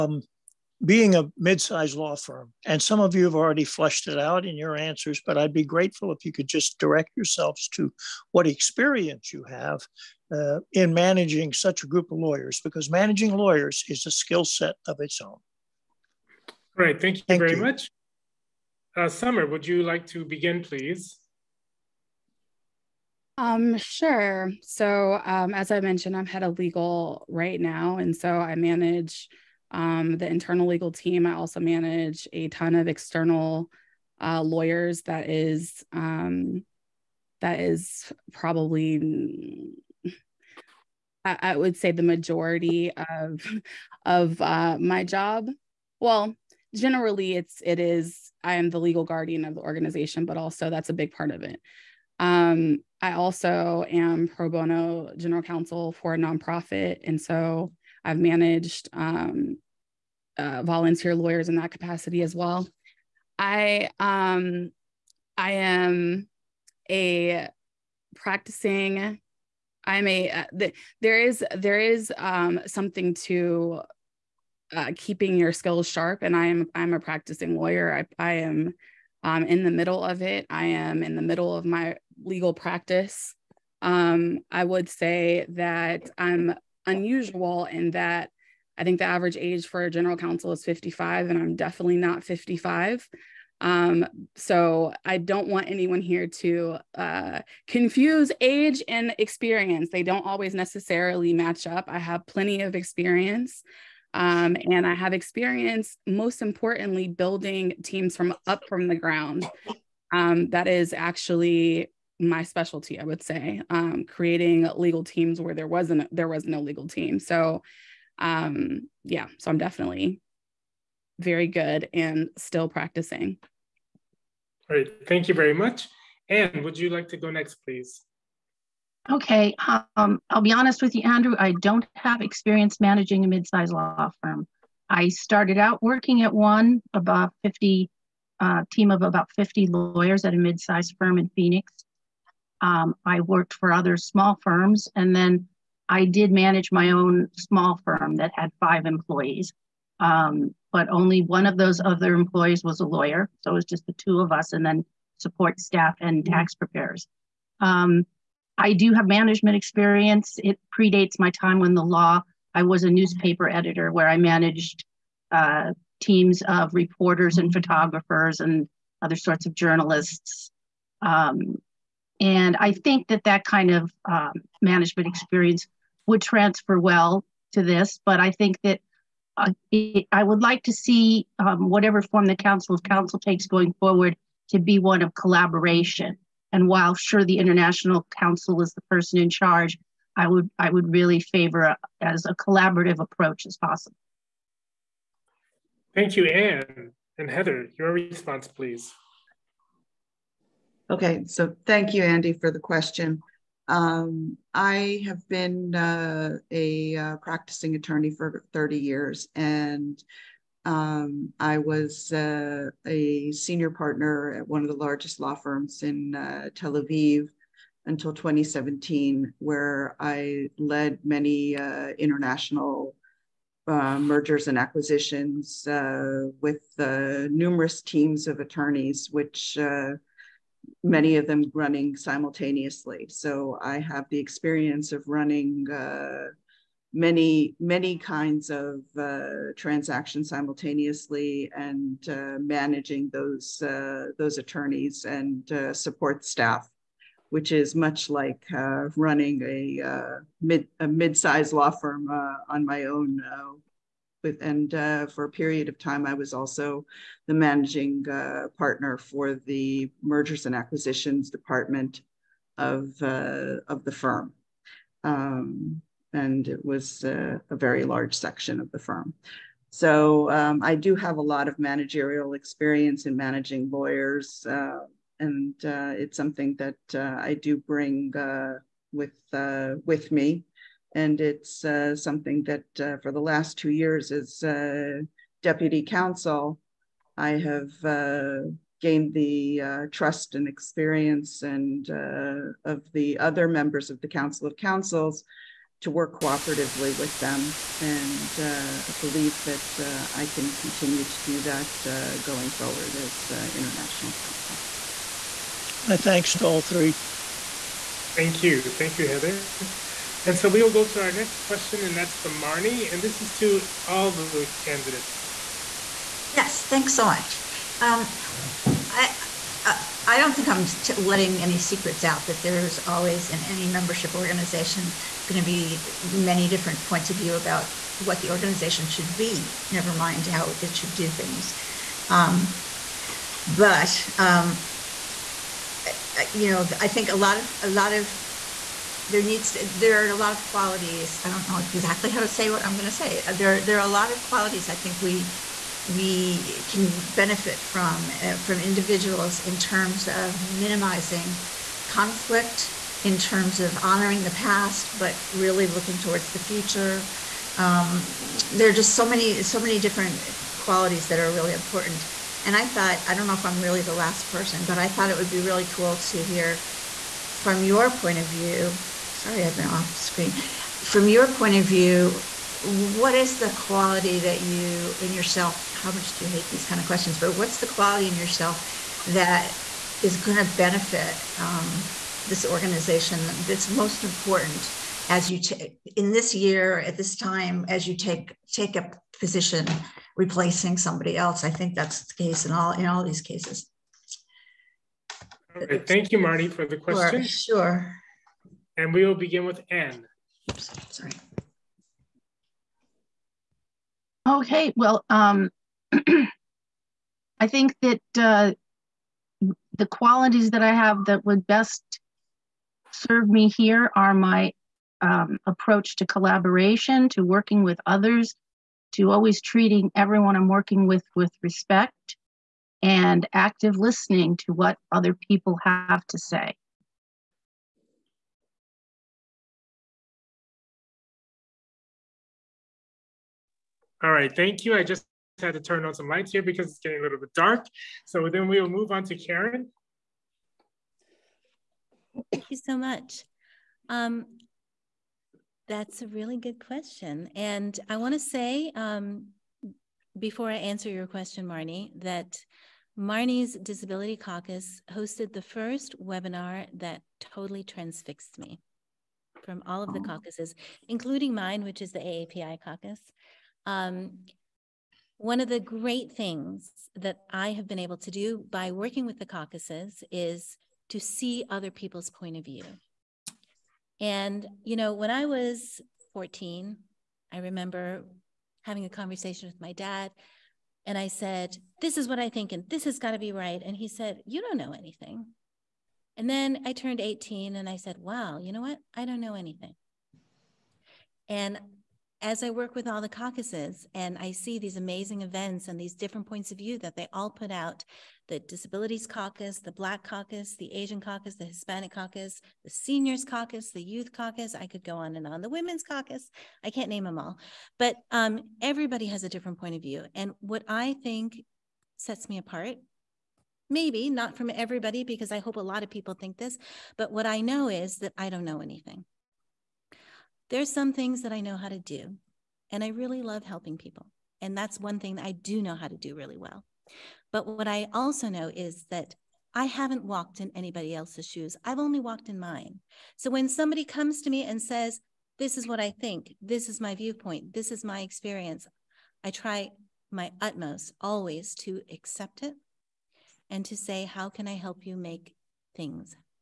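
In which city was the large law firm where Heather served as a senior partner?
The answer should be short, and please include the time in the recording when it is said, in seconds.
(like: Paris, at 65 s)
Tel Aviv, at 216 s.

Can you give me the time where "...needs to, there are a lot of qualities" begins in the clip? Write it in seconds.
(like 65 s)
339 s.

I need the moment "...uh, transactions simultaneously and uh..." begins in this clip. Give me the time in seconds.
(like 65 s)
238 s.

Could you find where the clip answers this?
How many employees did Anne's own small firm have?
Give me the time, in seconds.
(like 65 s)
148 s.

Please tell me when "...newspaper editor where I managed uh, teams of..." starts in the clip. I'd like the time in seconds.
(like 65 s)
162 s.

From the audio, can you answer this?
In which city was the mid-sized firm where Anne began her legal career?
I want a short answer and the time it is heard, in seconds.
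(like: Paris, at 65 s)
Phoenix, at 141 s.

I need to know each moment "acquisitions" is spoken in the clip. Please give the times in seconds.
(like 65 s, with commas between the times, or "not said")
224 s, 260 s.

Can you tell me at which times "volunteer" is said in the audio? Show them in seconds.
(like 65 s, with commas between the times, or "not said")
60 s.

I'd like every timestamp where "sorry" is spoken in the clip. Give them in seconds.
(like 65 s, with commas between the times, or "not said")
369 s, 400 s.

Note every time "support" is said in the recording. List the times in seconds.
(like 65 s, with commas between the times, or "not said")
155 s, 245 s.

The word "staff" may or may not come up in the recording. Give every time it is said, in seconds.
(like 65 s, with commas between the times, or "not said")
155 s, 246 s.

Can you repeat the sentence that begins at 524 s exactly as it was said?
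And that's one thing that I do know how to do really well.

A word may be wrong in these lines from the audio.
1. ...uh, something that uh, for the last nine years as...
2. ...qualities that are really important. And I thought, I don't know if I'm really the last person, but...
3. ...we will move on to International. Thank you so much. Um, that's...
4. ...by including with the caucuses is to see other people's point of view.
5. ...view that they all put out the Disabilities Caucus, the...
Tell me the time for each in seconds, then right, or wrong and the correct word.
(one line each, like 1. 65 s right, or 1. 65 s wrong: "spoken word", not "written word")
1. 281 s wrong: "two", not "nine"
2. 360 s right
3. 438 s wrong: "Karen", not "International"
4. 468 s wrong: "working", not "including"
5. 496 s right.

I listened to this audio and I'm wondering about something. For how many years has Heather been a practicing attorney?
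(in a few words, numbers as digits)
30.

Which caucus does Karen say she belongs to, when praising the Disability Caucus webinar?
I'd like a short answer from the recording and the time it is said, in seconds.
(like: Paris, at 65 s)
AAPI caucus, at 461 s.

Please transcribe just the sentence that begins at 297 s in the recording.
And believe that I can continue to do that going forward as International Counsel.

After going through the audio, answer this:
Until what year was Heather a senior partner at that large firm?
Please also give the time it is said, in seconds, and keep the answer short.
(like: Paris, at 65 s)
2017, at 218 s.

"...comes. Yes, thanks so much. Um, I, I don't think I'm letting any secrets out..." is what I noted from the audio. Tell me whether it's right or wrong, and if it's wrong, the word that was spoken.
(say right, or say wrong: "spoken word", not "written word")
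wrong: "candidates", not "comes".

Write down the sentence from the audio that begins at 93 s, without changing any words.
Um, so I don't want anyone here to uh, confuse age and experience.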